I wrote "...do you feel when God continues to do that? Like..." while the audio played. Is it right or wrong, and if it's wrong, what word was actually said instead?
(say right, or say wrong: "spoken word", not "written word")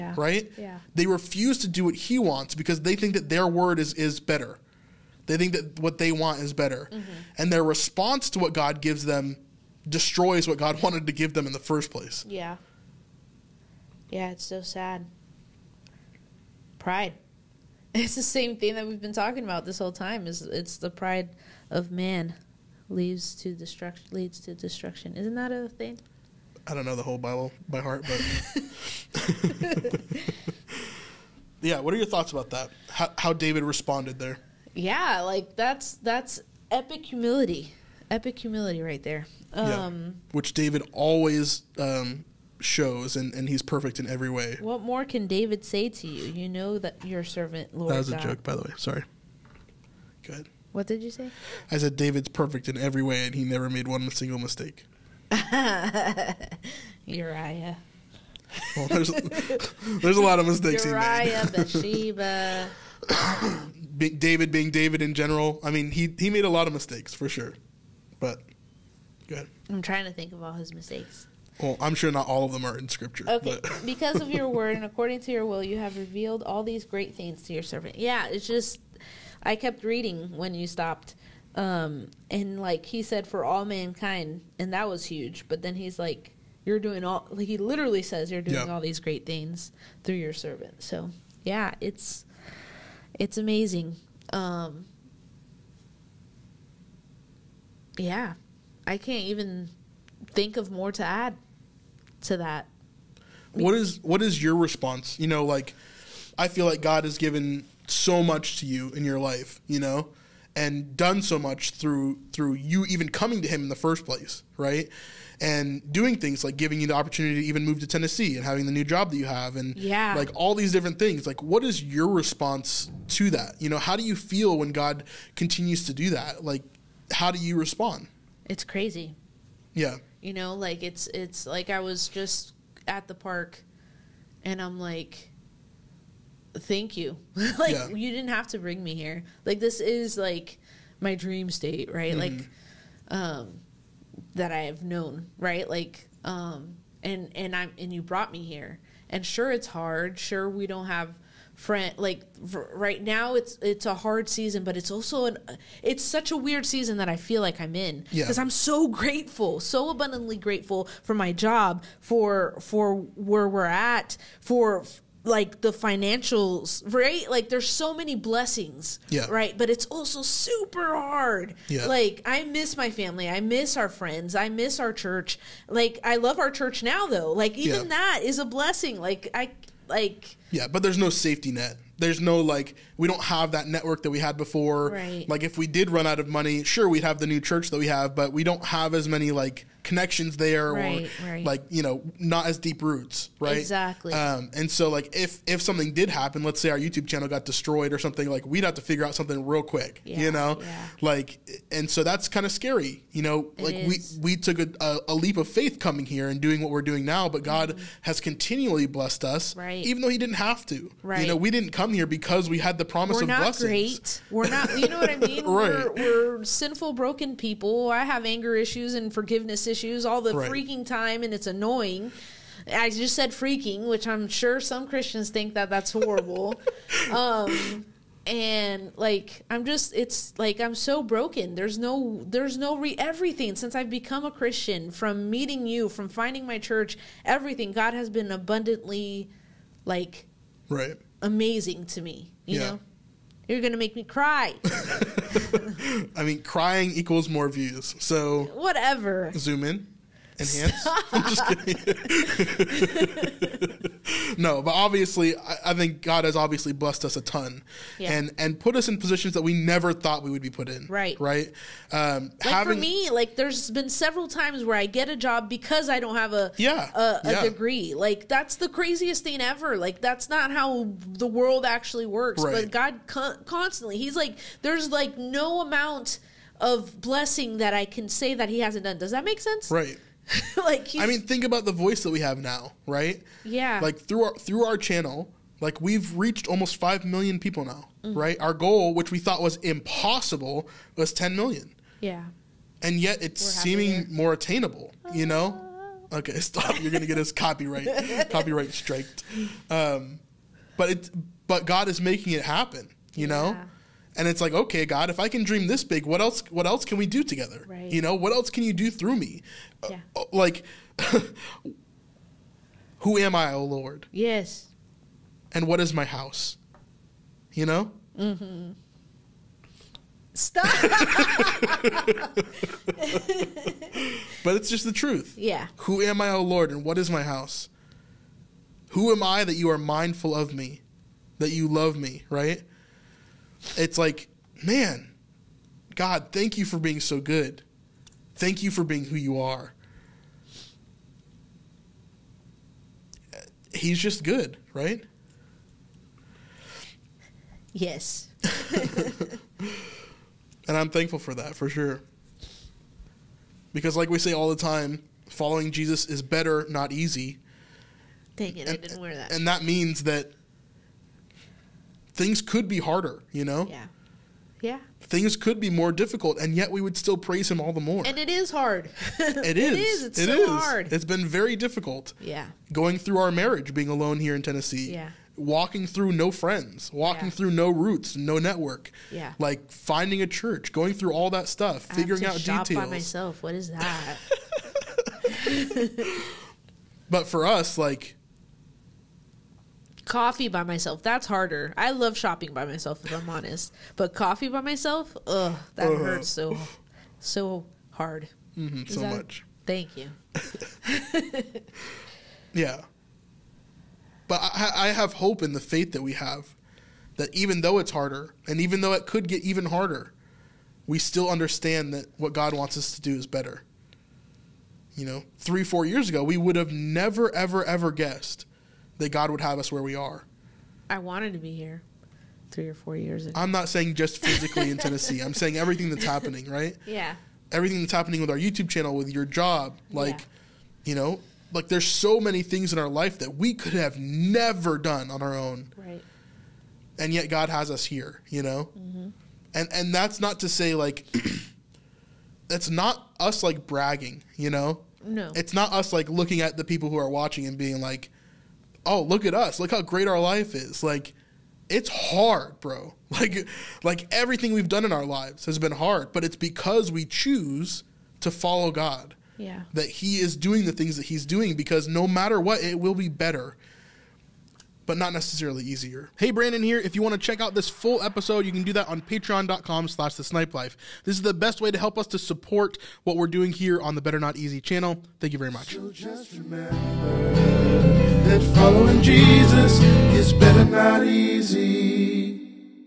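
right.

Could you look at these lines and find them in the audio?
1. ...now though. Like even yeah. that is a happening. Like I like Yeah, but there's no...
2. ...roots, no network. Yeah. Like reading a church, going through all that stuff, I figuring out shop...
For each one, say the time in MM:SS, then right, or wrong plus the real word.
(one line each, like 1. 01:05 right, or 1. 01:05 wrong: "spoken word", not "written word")
1. 02:56 wrong: "blessing", not "happening"
2. 06:17 wrong: "finding", not "reading".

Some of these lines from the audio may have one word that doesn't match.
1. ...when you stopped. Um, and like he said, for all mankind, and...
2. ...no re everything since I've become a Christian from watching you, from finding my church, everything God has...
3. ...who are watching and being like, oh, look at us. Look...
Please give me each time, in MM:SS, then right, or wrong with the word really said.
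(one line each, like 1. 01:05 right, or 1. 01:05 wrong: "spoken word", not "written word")
1. 01:20 right
2. 03:52 wrong: "meeting", not "watching"
3. 07:26 right.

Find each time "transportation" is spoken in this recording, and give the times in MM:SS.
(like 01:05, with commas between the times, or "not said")
not said.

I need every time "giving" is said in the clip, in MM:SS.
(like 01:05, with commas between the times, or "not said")
01:56.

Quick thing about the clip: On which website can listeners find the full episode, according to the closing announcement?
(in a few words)
patreon.com.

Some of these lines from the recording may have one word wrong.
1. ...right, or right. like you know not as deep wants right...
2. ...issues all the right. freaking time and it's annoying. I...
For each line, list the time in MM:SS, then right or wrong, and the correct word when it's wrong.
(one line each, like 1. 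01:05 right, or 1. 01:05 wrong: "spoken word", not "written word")
1. 03:10 wrong: "roots", not "wants"
2. 03:39 right.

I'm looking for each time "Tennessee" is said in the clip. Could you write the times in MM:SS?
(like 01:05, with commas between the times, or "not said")
01:57, 06:14, 07:04.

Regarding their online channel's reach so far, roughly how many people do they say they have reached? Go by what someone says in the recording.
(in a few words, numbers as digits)
5 million.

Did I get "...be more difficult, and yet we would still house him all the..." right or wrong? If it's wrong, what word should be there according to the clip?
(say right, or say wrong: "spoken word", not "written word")
wrong: "praise", not "house".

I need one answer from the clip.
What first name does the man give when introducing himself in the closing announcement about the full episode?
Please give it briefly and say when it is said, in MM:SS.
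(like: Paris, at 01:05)
Brandon, at 07:46.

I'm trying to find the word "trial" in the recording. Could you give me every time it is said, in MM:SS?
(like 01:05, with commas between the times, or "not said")
not said.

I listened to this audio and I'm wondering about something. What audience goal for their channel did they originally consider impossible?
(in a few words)
10 million.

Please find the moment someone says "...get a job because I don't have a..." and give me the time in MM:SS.
04:24.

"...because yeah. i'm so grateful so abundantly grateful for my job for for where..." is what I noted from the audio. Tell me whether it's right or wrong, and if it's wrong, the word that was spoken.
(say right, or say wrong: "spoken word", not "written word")
right.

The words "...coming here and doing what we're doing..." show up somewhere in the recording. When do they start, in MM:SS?
03:25.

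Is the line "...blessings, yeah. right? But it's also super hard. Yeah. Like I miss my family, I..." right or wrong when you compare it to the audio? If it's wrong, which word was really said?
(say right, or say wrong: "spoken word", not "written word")
right.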